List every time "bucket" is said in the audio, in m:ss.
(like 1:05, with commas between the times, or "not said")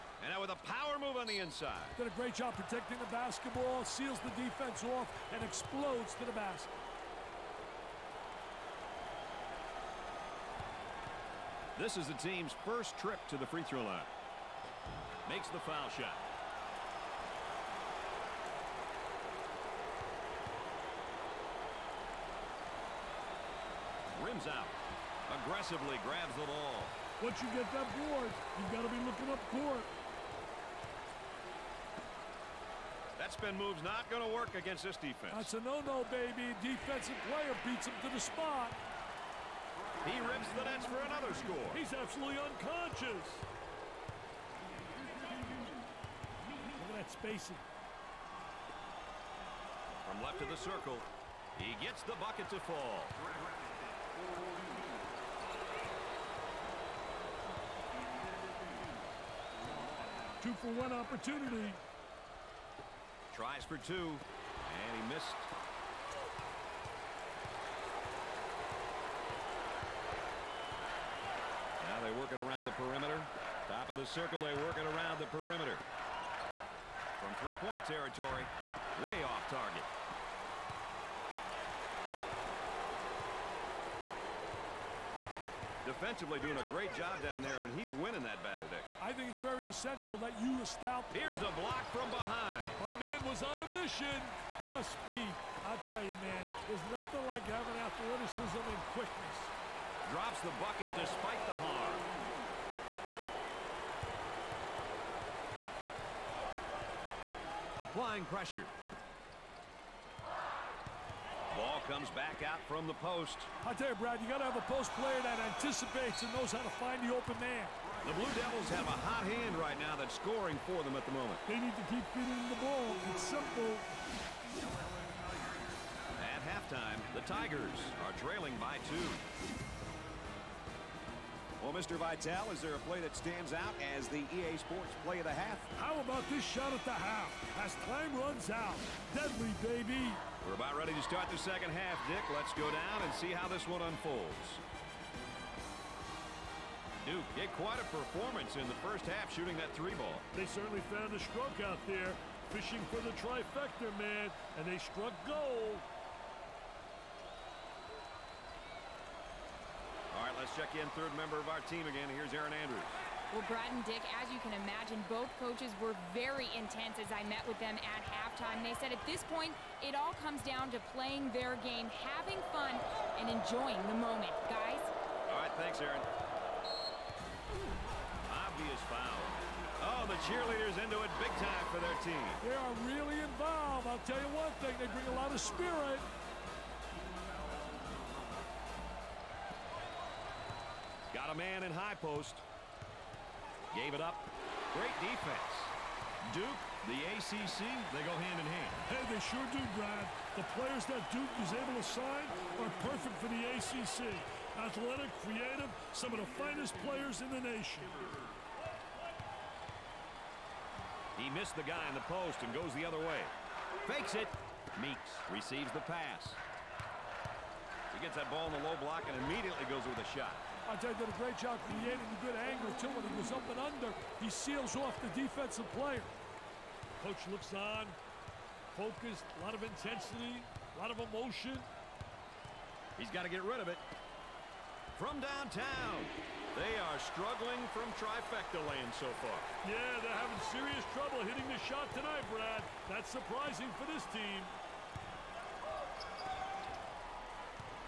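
0:52, 1:40.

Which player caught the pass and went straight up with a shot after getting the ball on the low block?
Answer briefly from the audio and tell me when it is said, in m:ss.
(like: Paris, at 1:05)
Meeks, at 3:34.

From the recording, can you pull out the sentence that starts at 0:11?
This is the team's first trip to the free throw line.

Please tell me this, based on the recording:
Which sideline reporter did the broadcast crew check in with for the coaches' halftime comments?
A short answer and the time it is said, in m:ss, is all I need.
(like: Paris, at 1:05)
Erin Andrews, at 2:42.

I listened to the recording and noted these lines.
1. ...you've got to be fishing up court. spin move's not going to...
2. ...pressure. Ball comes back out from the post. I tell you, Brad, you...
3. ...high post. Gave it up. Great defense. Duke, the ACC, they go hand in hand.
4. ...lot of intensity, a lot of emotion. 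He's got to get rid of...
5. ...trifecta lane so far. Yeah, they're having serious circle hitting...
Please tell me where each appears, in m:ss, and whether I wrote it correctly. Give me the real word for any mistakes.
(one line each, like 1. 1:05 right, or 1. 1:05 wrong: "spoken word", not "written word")
1. 0:28 wrong: "looking", not "fishing"
2. 1:48 right
3. 3:11 right
4. 3:49 right
5. 3:57 wrong: "trouble", not "circle".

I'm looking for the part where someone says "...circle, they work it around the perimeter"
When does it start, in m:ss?
1:14.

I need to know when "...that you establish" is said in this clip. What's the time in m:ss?
1:30.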